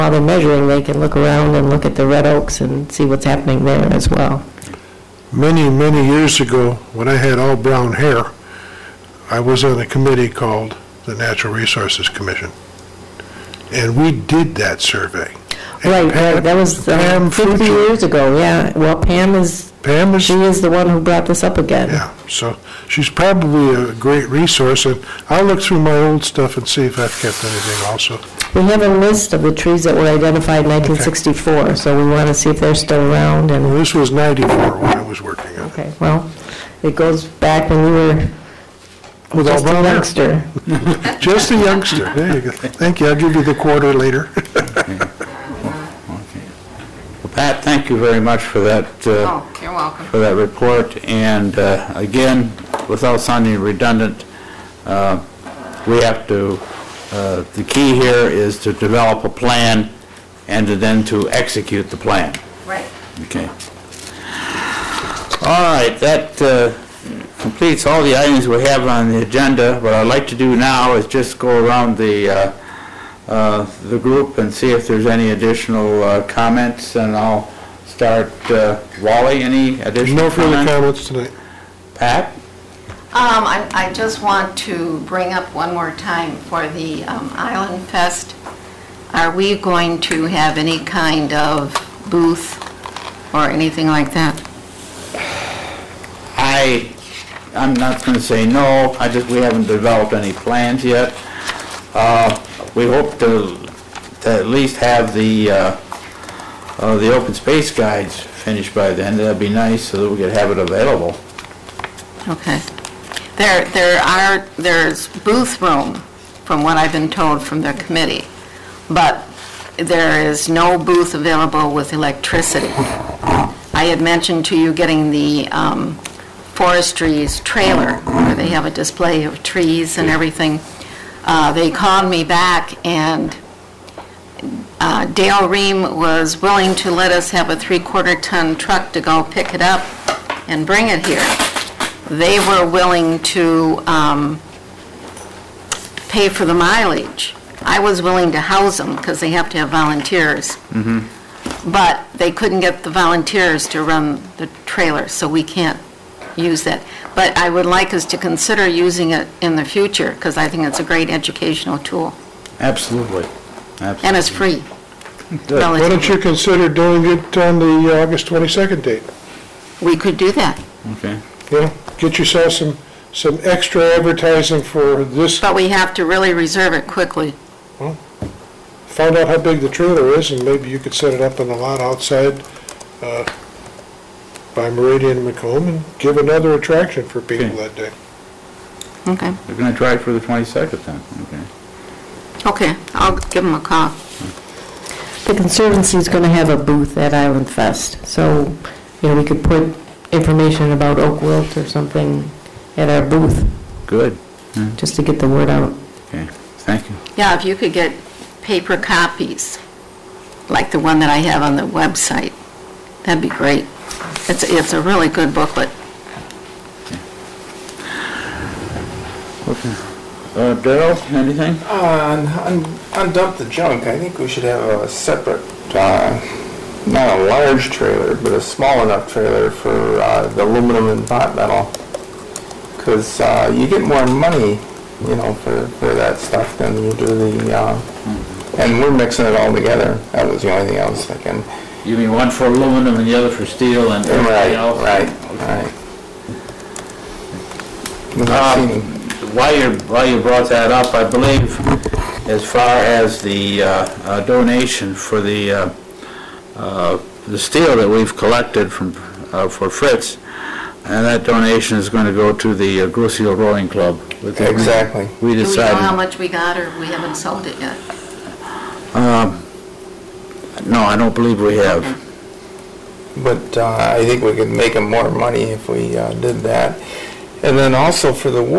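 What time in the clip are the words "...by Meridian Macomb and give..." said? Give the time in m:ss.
3:04.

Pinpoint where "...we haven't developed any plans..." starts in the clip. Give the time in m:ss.
1:39.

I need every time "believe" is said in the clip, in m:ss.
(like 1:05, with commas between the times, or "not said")
4:11, 4:31.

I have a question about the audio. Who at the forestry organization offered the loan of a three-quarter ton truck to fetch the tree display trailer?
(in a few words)
Dale Ream.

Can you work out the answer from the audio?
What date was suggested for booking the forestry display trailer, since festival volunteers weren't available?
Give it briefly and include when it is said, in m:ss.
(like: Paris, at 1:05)
August 22nd, at 2:48.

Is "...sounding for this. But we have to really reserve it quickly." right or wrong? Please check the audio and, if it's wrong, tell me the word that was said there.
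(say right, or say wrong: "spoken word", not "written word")
wrong: "advertising", not "sounding".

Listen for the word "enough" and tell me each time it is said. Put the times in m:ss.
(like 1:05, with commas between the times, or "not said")
3:48.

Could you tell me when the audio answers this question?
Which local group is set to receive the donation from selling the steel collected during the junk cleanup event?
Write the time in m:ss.
4:22.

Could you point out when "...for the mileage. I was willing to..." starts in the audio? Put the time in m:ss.
2:26.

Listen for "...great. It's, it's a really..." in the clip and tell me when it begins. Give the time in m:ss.
3:33.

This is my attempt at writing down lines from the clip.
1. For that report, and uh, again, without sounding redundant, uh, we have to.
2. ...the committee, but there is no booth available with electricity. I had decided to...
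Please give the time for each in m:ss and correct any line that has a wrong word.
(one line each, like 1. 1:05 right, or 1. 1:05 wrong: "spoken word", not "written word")
1. 0:50 right
2. 1:57 wrong: "mentioned", not "decided".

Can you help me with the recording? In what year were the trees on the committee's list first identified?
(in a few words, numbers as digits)
1964.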